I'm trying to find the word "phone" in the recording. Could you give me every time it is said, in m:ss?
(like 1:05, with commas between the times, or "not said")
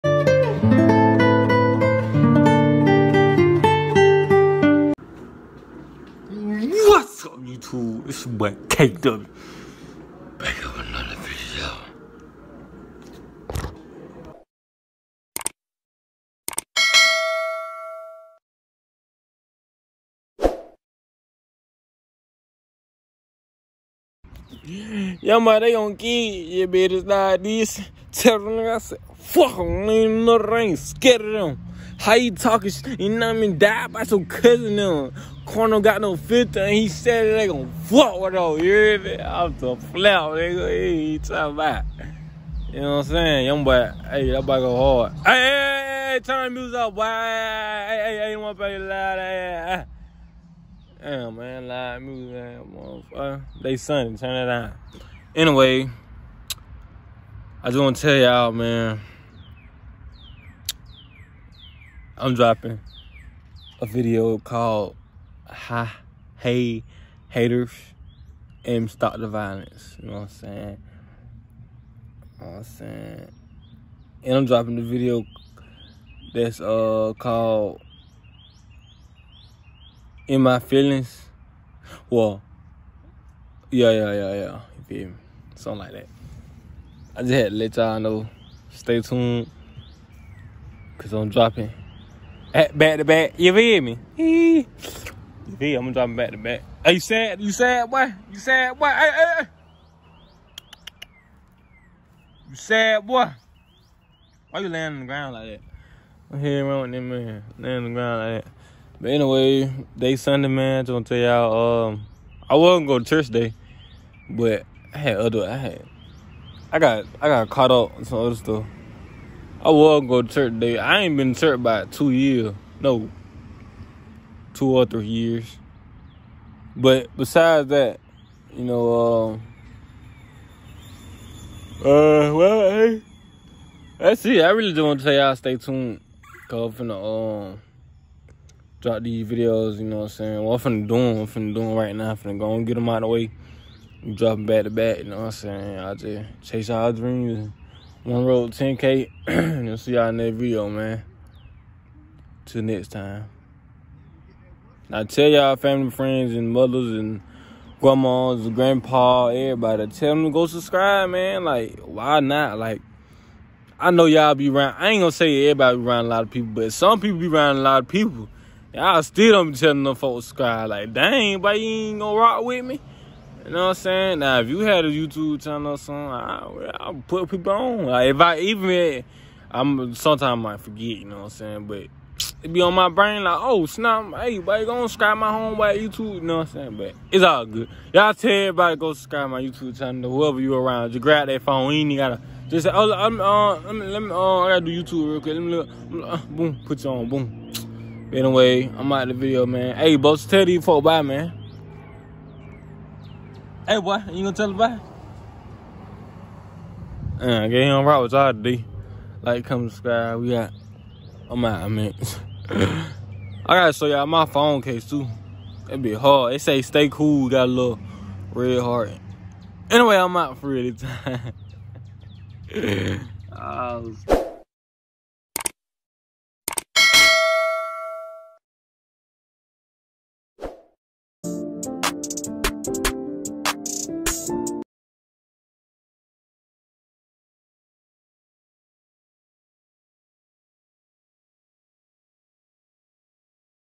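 3:11, 3:34.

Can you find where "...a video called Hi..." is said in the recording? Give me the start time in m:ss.
1:03.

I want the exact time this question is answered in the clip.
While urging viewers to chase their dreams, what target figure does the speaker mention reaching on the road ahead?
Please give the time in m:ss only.
2:28.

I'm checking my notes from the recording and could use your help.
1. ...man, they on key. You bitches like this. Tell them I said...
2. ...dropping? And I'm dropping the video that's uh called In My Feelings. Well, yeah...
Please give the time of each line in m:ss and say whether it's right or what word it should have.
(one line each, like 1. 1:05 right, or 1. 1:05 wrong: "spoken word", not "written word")
1. 0:25 right
2. 1:12 wrong: "saying", not "dropping".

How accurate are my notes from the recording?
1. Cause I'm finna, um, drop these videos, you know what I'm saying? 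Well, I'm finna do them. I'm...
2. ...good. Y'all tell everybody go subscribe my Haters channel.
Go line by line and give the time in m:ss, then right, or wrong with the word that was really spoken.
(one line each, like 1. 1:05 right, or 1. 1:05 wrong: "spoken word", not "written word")
1. 2:16 right
2. 3:07 wrong: "YouTube", not "Haters".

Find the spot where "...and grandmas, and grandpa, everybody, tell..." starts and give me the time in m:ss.
2:36.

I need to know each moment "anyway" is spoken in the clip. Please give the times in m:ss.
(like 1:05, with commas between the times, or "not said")
0:55, 1:49, 3:18, 3:39.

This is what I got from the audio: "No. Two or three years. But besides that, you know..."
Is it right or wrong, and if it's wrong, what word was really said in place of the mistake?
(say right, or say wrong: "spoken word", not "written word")
right.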